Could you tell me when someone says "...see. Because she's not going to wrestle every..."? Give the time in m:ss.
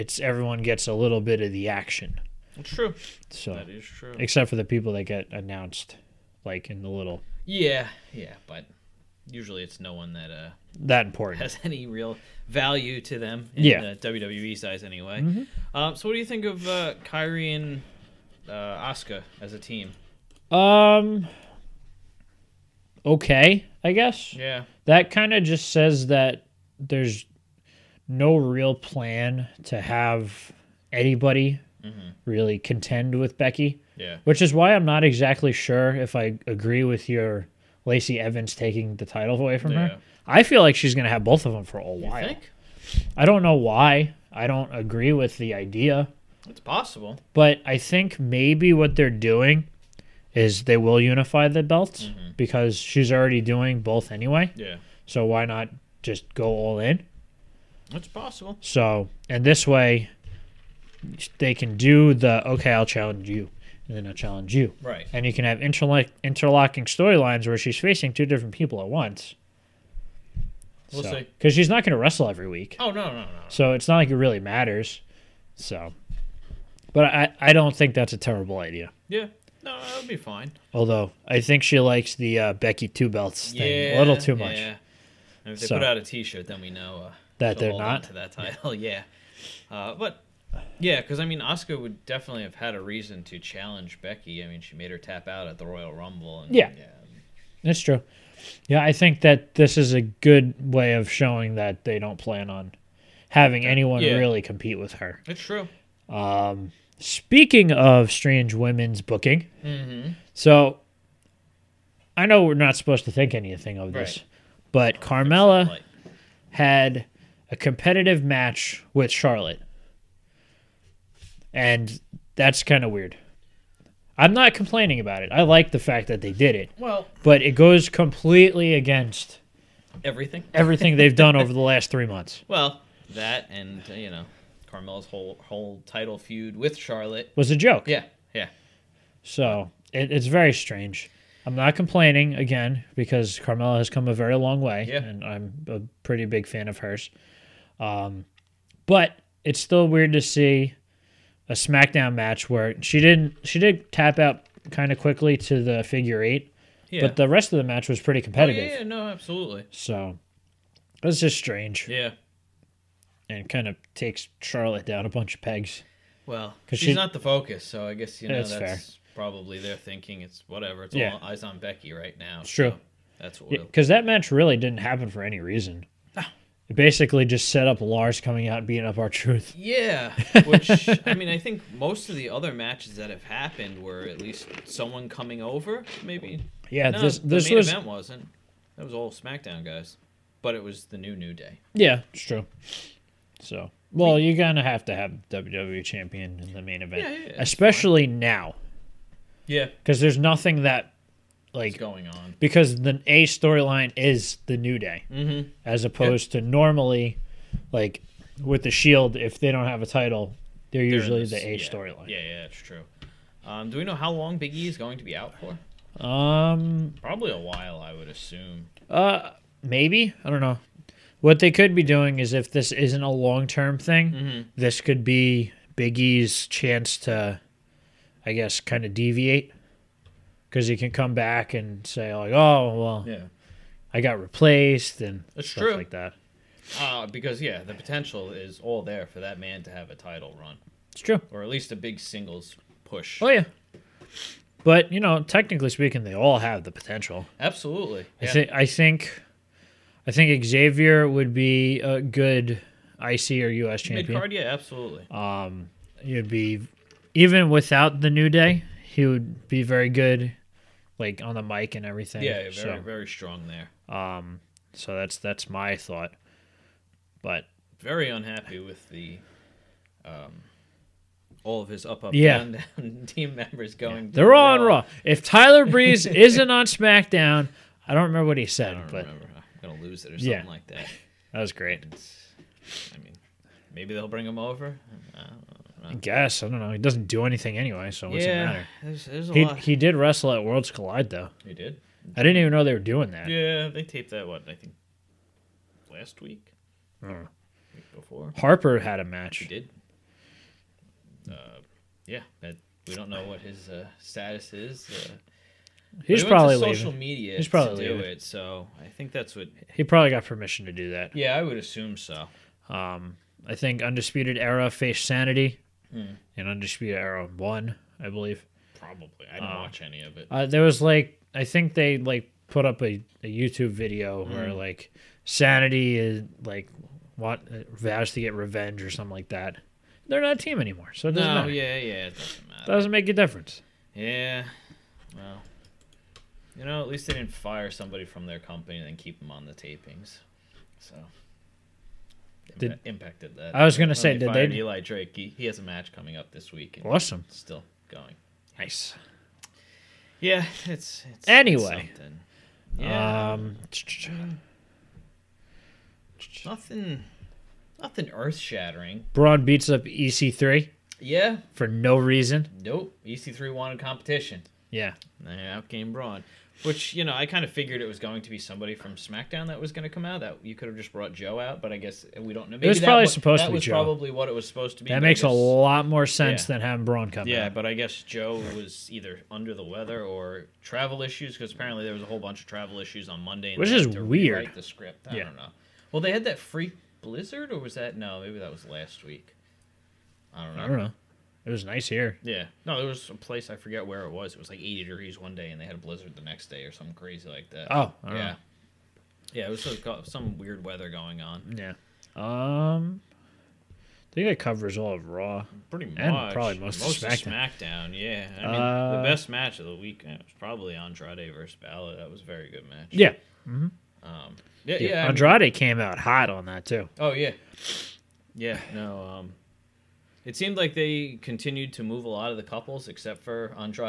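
1:11.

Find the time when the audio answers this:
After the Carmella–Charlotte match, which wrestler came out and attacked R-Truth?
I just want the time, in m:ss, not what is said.
2:57.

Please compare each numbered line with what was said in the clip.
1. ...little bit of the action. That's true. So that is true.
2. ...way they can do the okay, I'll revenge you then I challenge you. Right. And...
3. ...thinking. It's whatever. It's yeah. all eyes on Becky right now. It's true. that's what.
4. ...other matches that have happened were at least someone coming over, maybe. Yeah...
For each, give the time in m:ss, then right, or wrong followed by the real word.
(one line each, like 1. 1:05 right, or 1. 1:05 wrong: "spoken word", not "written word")
1. 0:00 right
2. 0:59 wrong: "challenge", not "revenge"
3. 2:49 right
4. 3:02 right.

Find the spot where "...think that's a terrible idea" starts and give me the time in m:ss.
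1:17.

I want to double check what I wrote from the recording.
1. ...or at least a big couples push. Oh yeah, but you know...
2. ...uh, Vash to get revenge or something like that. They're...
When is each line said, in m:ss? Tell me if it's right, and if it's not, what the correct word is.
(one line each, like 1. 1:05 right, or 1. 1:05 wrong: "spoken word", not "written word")
1. 4:01 wrong: "singles", not "couples"
2. 5:27 right.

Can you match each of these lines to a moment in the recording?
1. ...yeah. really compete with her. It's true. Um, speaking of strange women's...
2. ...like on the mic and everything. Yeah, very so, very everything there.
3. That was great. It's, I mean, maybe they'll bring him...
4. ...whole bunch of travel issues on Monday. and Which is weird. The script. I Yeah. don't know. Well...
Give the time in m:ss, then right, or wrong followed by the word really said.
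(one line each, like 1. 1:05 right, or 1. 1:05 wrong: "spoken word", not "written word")
1. 1:44 right
2. 4:20 wrong: "strong", not "everything"
3. 4:41 right
4. 6:22 right.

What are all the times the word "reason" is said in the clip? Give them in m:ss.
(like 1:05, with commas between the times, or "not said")
1:32, 2:55, 6:01.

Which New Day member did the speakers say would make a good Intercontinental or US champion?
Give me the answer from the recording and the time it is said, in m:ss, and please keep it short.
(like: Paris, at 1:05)
Xavier, at 4:10.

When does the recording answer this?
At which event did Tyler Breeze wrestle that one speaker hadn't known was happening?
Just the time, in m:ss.
4:50.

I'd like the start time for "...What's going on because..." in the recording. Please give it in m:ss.
3:21.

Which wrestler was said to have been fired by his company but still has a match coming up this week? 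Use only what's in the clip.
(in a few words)
Eli Drake.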